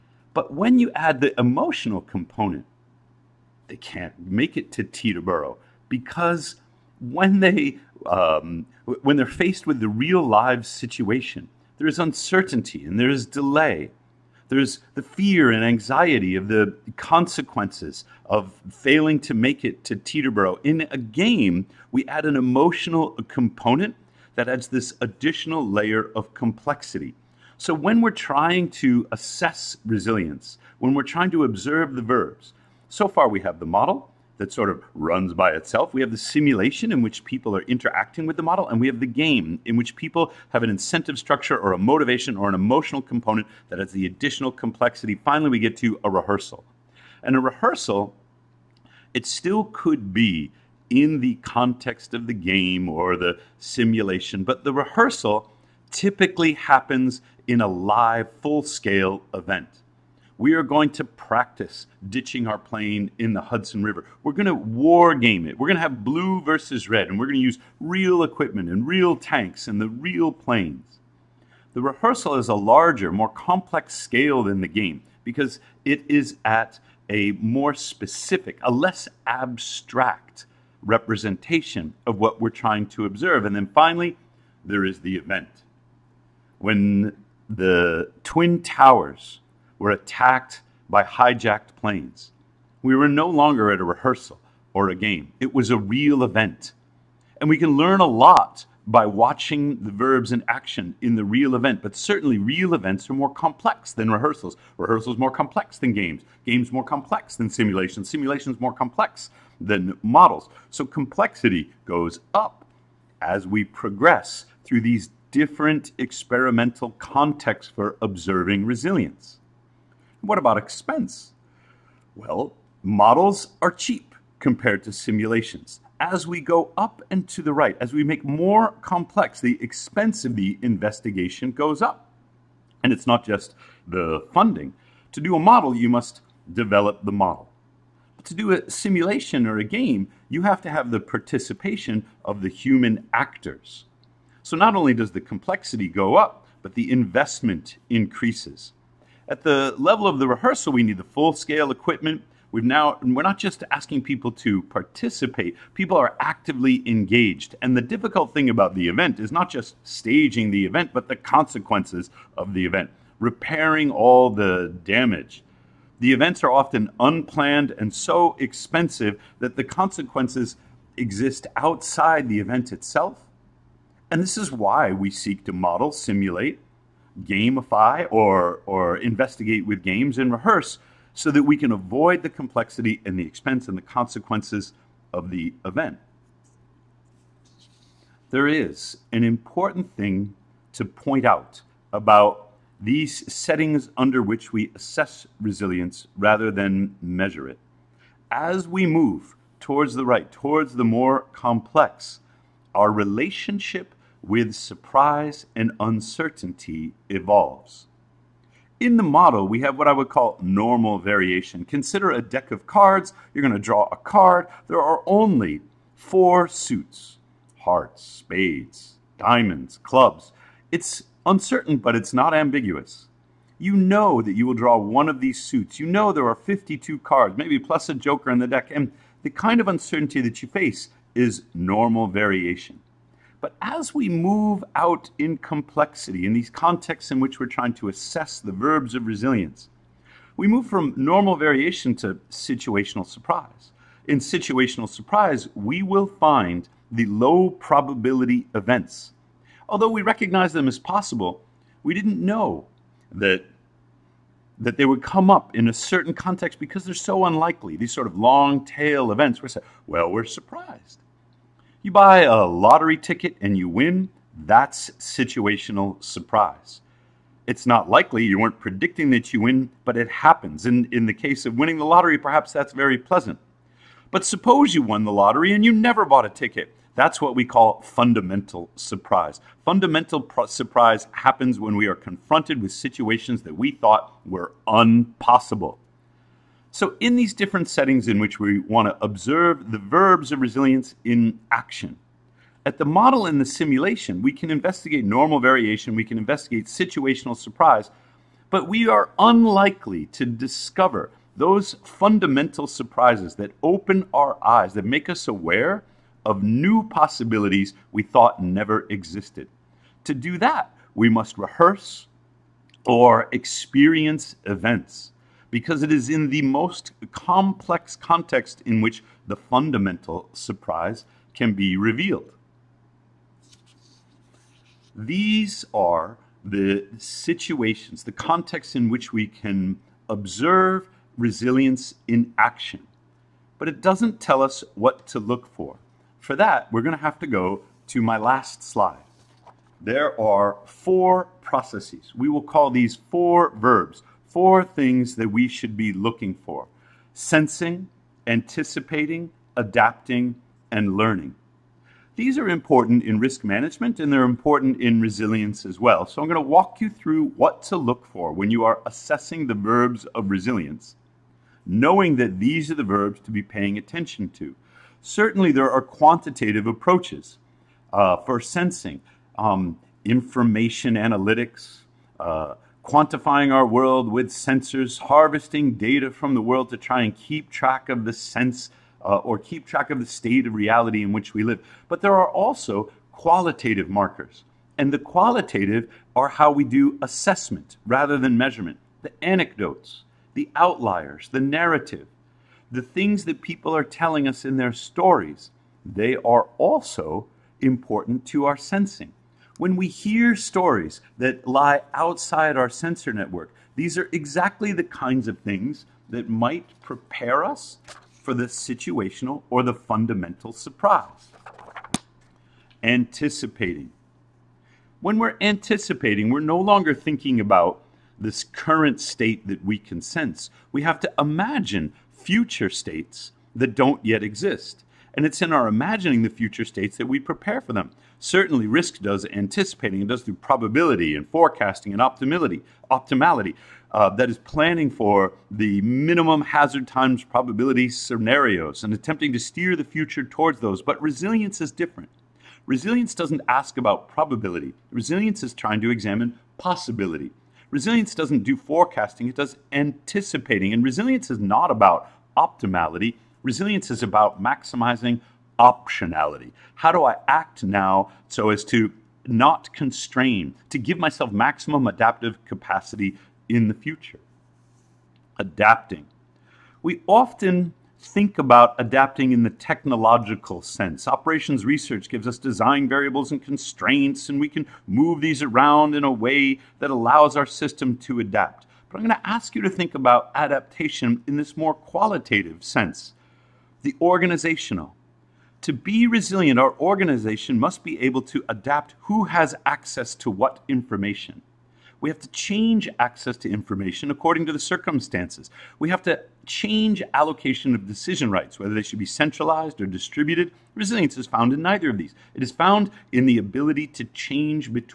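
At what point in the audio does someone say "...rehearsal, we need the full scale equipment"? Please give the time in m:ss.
2:30.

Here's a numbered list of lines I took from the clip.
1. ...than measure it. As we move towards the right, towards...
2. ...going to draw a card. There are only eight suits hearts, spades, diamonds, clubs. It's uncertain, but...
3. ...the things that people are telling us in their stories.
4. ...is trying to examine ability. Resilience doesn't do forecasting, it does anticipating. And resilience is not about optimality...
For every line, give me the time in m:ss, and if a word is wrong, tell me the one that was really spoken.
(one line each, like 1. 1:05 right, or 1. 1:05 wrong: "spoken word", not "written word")
1. 3:16 right
2. 3:33 wrong: "four", not "eight"
3. 6:32 right
4. 7:25 wrong: "possibility", not "ability".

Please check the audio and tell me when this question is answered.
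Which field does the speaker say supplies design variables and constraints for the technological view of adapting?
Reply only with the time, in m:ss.
7:51.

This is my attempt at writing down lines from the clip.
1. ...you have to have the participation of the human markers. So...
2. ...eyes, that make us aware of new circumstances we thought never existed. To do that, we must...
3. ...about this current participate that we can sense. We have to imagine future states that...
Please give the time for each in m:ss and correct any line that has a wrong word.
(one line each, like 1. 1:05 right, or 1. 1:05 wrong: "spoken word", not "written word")
1. 2:20 wrong: "actors", not "markers"
2. 5:04 wrong: "possibilities", not "circumstances"
3. 6:57 wrong: "state", not "participate".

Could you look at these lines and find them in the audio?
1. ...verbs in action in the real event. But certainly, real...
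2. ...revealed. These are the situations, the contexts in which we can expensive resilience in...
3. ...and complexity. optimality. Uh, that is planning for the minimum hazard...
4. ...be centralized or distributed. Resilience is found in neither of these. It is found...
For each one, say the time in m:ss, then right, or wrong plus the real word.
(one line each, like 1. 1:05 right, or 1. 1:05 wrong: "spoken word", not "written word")
1. 1:39 right
2. 5:21 wrong: "observe", not "expensive"
3. 7:11 wrong: "optimality", not "complexity"
4. 8:19 right.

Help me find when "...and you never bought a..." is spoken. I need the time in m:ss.
4:35.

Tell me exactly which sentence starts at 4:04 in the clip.
In situational surprise, we will find the low probability events.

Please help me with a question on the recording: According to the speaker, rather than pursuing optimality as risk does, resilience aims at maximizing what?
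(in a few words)
optionality.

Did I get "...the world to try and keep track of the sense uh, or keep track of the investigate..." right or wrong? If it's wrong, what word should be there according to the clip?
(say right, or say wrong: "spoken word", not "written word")
wrong: "state", not "investigate".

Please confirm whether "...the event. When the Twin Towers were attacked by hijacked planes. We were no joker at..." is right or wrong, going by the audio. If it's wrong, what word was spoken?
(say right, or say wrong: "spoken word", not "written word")
wrong: "longer", not "joker".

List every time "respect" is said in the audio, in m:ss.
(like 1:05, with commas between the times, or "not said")
not said.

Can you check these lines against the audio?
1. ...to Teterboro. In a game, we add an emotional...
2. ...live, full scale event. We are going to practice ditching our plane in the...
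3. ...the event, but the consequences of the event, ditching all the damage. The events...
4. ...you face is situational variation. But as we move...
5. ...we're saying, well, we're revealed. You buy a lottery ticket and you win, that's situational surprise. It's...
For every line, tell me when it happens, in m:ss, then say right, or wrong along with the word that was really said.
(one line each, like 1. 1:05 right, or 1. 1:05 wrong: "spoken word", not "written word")
1. 0:19 right
2. 0:57 right
3. 2:40 wrong: "repairing", not "ditching"
4. 3:50 wrong: "normal", not "situational"
5. 4:19 wrong: "surprised", not "revealed".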